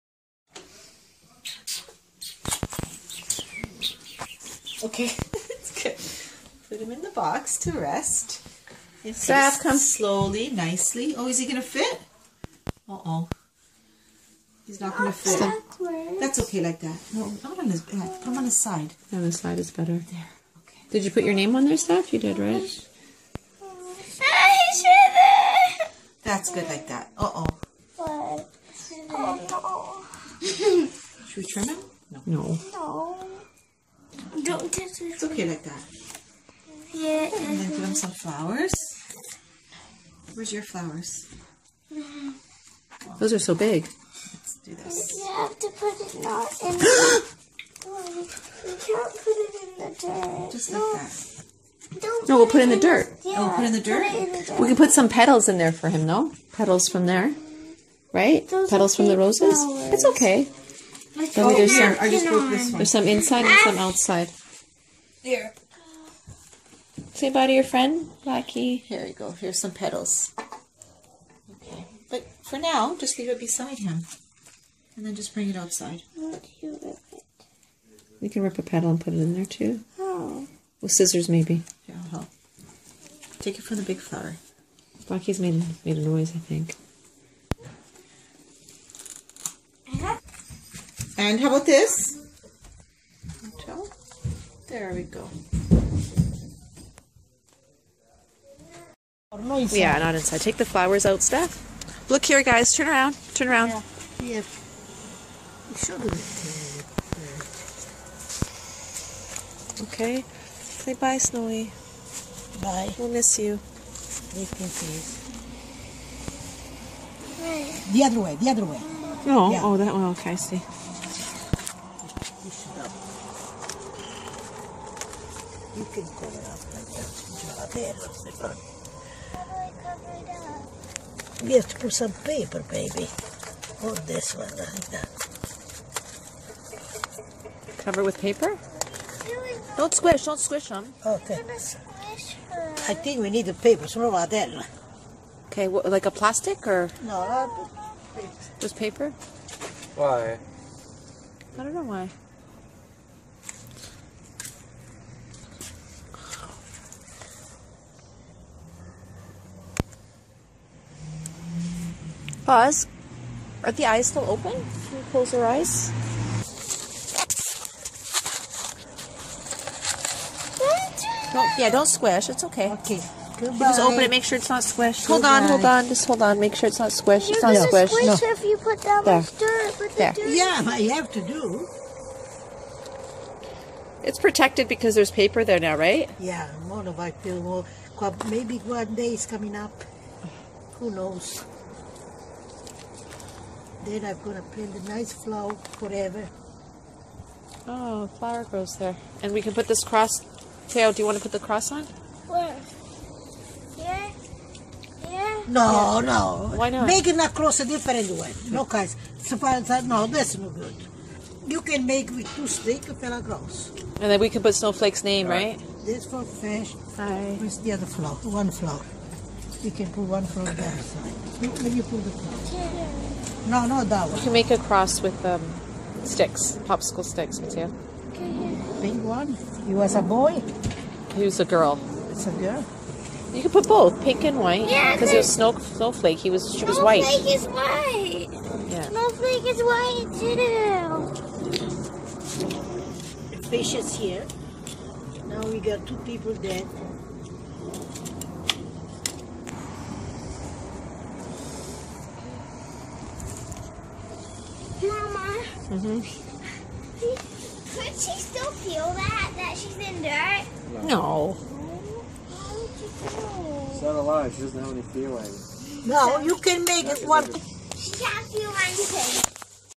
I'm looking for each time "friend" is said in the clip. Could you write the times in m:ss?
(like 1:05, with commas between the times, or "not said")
1:07.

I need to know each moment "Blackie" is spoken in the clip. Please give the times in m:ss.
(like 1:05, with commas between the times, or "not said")
1:08, 1:25.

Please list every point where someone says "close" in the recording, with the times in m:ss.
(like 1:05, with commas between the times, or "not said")
2:45.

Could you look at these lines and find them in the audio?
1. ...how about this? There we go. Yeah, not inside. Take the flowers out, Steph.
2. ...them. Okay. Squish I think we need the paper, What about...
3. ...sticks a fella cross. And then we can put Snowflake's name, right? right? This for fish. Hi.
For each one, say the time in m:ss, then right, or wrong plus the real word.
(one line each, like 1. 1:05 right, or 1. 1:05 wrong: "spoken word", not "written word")
1. 1:31 right
2. 2:20 right
3. 3:32 right.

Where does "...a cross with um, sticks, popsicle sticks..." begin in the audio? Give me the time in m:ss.
3:44.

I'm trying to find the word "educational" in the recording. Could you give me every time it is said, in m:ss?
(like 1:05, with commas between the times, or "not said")
not said.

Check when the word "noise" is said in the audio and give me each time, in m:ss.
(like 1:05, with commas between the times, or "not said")
1:26.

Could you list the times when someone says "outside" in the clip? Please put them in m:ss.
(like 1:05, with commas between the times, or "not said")
1:03, 1:15.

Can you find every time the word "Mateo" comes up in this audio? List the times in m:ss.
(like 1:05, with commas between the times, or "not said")
3:47.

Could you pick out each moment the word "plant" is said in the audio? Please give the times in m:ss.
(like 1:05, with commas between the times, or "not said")
3:14.